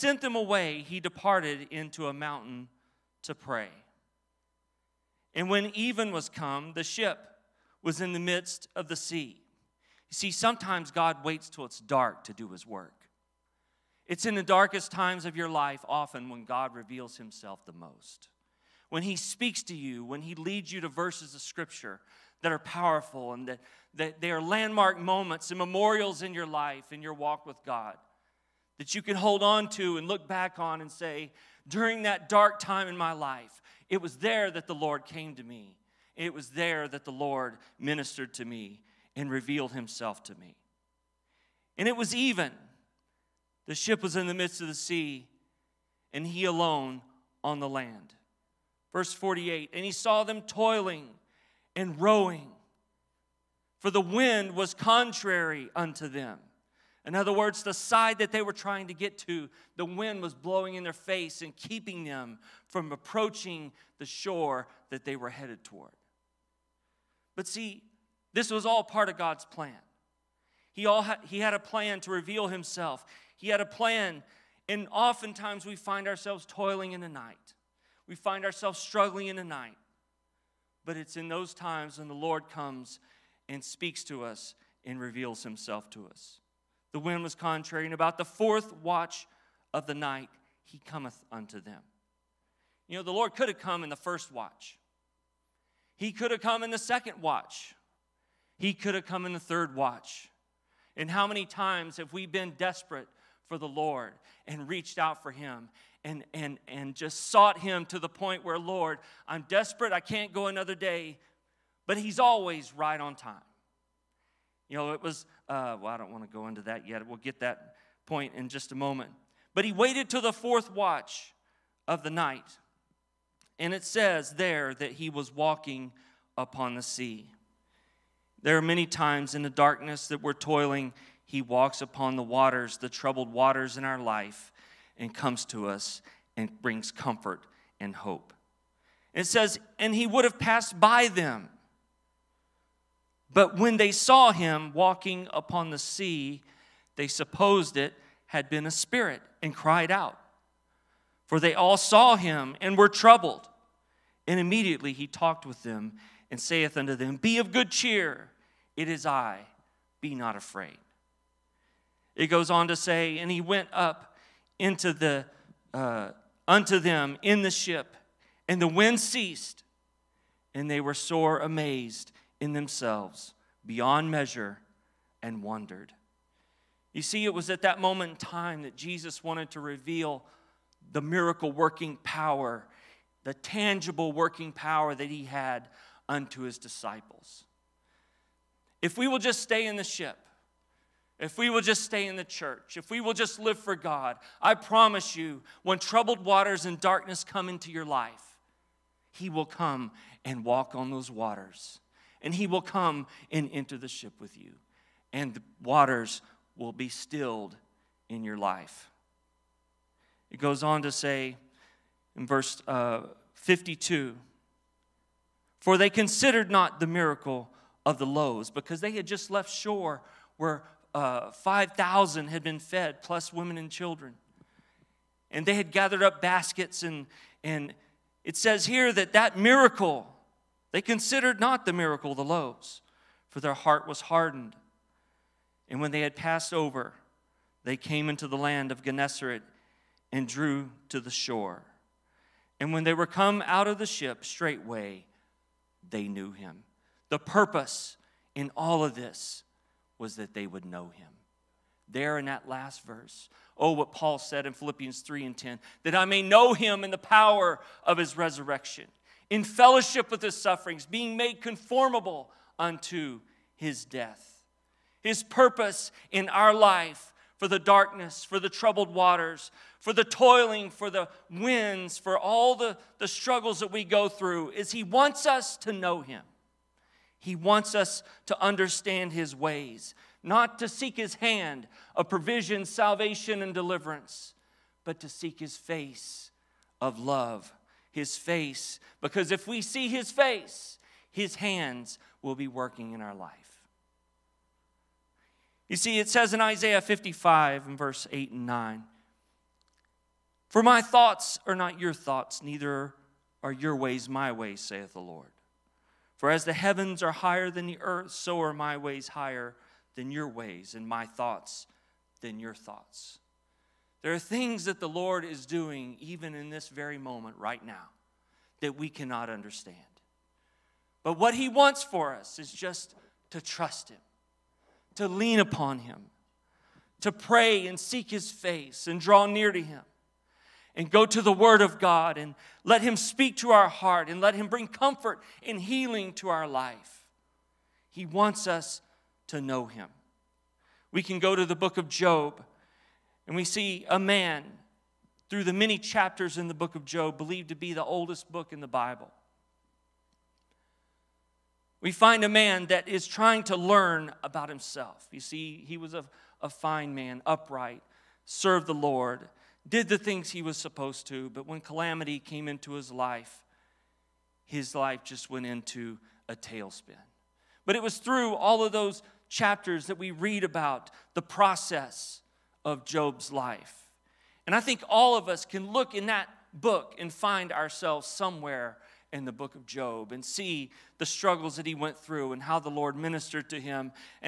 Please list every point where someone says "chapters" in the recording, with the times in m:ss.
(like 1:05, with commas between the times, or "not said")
5:45, 6:09.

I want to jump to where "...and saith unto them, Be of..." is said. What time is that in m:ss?
2:36.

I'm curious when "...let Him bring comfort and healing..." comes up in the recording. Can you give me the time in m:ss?
5:34.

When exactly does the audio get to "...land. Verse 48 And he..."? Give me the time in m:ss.
0:47.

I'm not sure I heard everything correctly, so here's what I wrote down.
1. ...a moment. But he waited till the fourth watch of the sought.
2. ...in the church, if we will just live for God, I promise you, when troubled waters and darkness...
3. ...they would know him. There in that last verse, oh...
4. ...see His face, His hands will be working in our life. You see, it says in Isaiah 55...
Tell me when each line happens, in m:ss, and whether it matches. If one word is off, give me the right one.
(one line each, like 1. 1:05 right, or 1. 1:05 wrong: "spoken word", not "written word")
1. 1:58 wrong: "night", not "sought"
2. 3:12 right
3. 4:10 right
4. 4:49 right.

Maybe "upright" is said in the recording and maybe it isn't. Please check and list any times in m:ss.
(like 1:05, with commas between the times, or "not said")
5:57.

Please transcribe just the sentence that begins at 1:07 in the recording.
But see, this was all part of God's plan.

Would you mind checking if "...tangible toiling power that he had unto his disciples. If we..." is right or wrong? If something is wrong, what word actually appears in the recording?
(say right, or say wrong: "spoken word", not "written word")
wrong: "working", not "toiling".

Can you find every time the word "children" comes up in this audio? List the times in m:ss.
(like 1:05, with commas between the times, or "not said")
3:43.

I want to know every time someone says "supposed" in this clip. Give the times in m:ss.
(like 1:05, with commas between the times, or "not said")
2:27, 6:00.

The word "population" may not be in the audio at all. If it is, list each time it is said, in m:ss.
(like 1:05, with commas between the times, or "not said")
not said.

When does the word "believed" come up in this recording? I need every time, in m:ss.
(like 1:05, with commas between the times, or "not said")
5:47.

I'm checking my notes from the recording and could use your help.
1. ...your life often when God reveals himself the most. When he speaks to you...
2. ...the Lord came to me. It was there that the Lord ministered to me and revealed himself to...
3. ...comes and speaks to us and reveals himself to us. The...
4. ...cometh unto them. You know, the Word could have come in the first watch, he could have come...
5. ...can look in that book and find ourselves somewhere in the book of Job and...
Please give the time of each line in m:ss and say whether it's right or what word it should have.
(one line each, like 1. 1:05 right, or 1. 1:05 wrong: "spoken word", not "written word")
1. 0:15 right
2. 0:34 right
3. 1:22 right
4. 1:30 wrong: "Lord", not "Word"
5. 6:15 right.